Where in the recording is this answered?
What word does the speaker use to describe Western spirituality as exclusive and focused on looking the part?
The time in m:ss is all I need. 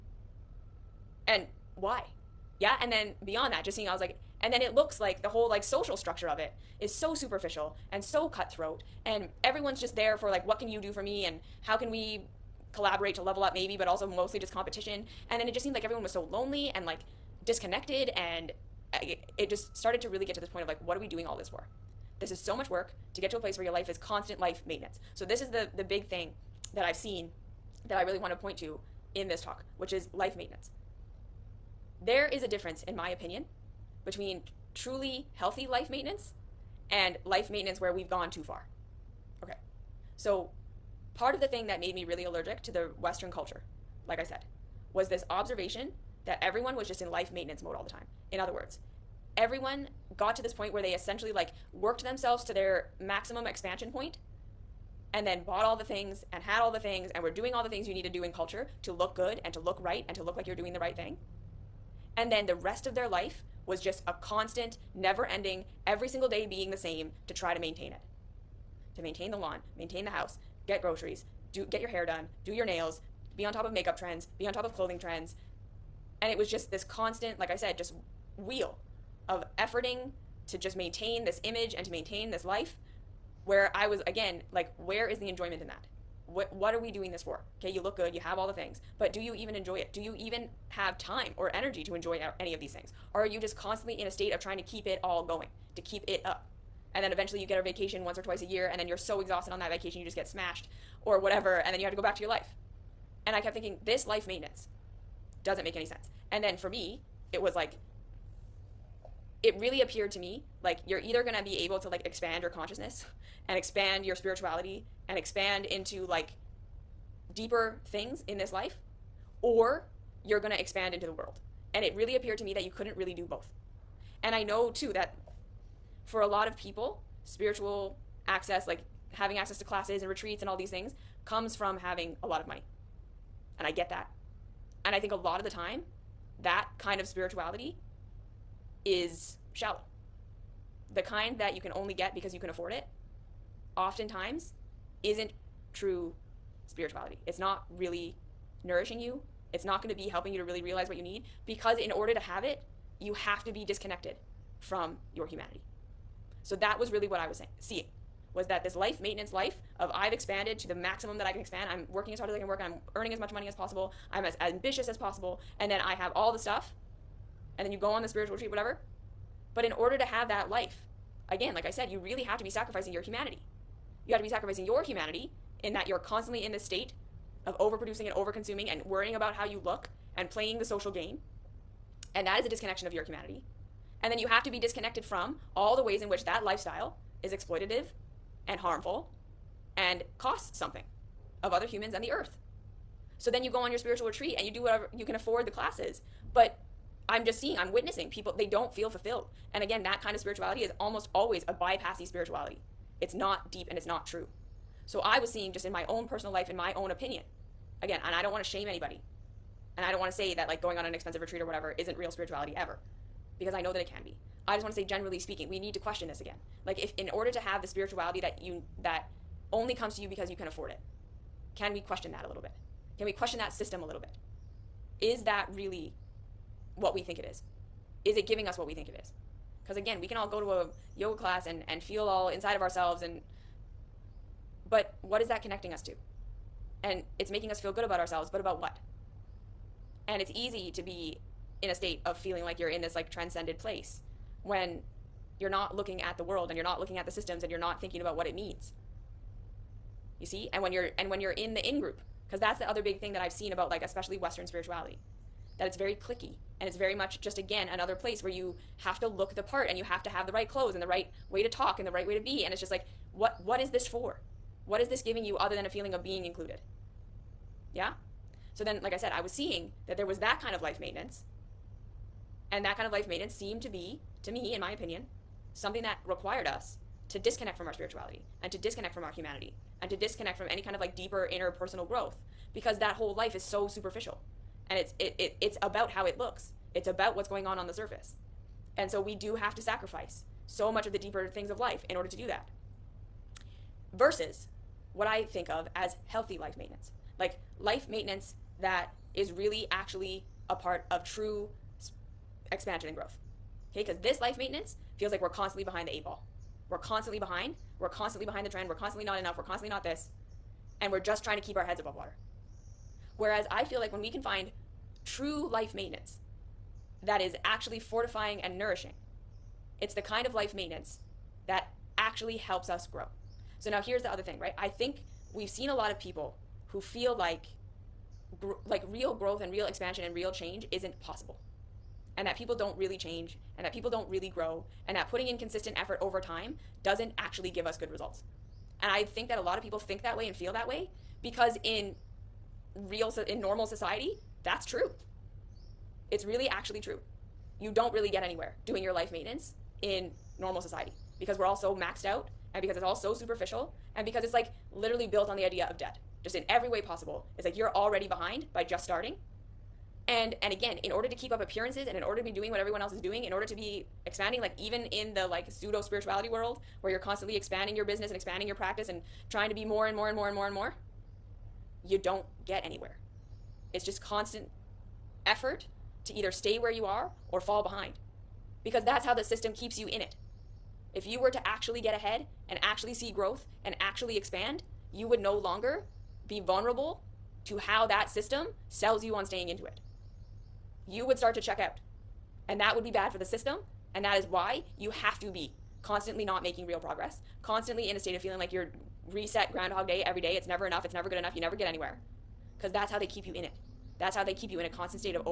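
4:16.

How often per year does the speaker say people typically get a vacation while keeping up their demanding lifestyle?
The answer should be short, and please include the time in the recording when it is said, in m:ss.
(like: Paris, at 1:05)
Once or twice, at 1:38.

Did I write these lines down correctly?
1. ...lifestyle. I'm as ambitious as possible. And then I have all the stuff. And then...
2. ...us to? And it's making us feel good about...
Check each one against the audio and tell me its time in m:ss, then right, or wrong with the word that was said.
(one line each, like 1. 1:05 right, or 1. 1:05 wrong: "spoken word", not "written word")
1. 2:43 wrong: "possible", not "lifestyle"
2. 3:55 right.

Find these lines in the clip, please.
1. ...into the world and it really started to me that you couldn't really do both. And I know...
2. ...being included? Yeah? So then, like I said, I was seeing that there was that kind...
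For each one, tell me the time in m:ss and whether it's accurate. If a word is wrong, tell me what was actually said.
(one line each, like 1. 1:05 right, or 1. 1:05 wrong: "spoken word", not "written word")
1. 2:00 wrong: "appeared", not "started"
2. 4:26 right.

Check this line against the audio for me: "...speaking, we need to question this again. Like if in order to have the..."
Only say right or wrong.
right.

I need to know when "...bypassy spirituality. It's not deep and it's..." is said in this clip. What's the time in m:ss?
3:21.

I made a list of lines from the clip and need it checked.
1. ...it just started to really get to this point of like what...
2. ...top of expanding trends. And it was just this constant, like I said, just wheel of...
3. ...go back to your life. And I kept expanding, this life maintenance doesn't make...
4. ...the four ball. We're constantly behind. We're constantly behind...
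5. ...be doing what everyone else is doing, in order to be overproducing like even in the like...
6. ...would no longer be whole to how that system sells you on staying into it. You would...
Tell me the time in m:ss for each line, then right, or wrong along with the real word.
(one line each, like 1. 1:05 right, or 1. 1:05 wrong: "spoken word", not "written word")
1. 0:19 right
2. 1:14 wrong: "clothing", not "expanding"
3. 1:41 wrong: "thinking", not "expanding"
4. 5:05 wrong: "eight", not "four"
5. 6:02 wrong: "expanding", not "overproducing"
6. 6:25 wrong: "vulnerable", not "whole".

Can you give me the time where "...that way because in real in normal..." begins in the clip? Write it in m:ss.
5:40.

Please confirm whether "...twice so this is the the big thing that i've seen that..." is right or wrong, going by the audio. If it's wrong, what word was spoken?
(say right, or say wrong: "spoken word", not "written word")
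wrong: "maintenance", not "twice".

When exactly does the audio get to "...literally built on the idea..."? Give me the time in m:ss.
5:54.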